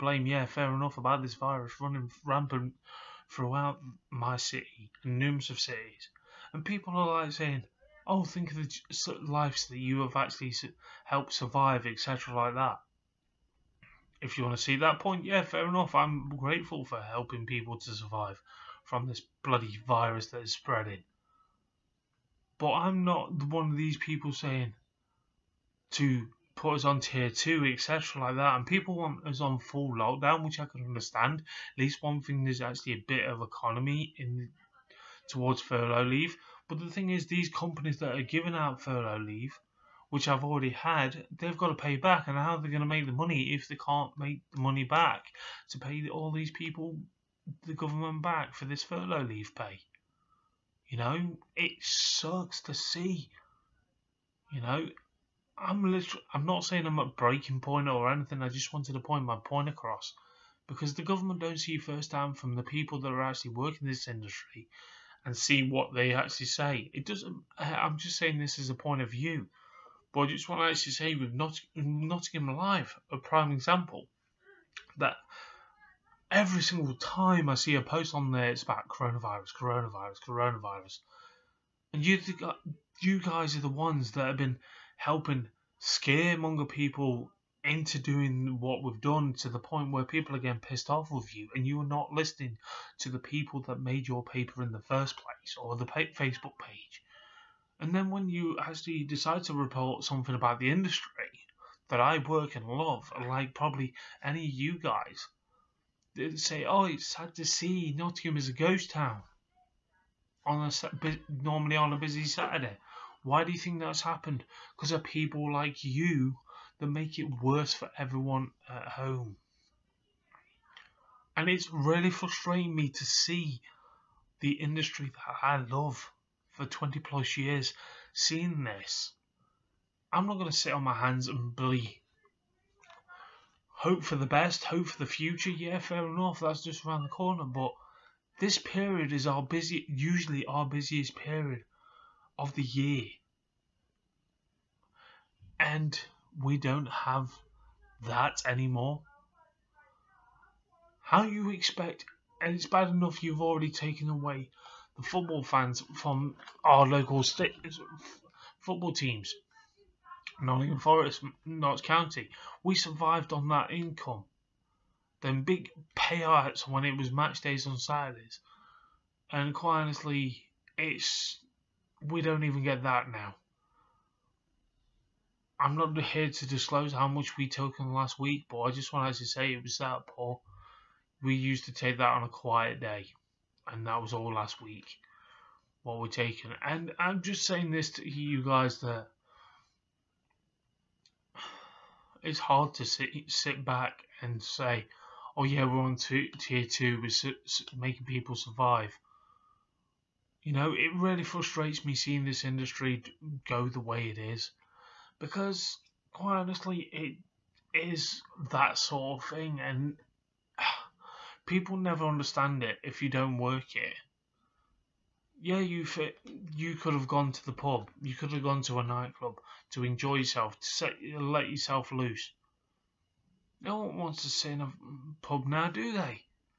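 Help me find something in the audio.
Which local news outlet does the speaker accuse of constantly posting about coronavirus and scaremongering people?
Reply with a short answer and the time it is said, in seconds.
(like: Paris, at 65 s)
Nottingham Live, at 71 s.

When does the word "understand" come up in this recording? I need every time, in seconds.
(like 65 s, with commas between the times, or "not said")
30 s, 212 s.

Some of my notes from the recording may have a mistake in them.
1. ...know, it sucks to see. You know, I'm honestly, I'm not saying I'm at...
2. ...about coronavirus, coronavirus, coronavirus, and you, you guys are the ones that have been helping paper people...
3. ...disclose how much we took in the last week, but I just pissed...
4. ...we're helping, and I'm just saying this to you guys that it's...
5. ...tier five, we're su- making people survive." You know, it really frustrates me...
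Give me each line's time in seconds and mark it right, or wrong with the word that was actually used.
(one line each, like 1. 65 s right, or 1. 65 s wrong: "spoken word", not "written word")
1. 50 s wrong: "literally", not "honestly"
2. 78 s wrong: "scaremonger", not "paper"
3. 176 s wrong: "wanted", not "pissed"
4. 185 s wrong: "taking", not "helping"
5. 196 s wrong: "two", not "five".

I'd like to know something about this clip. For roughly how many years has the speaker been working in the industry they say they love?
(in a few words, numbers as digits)
20 plus years.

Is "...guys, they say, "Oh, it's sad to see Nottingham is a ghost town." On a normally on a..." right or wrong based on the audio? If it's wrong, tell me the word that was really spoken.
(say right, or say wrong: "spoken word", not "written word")
right.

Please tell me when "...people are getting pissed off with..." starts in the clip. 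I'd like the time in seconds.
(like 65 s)
90 s.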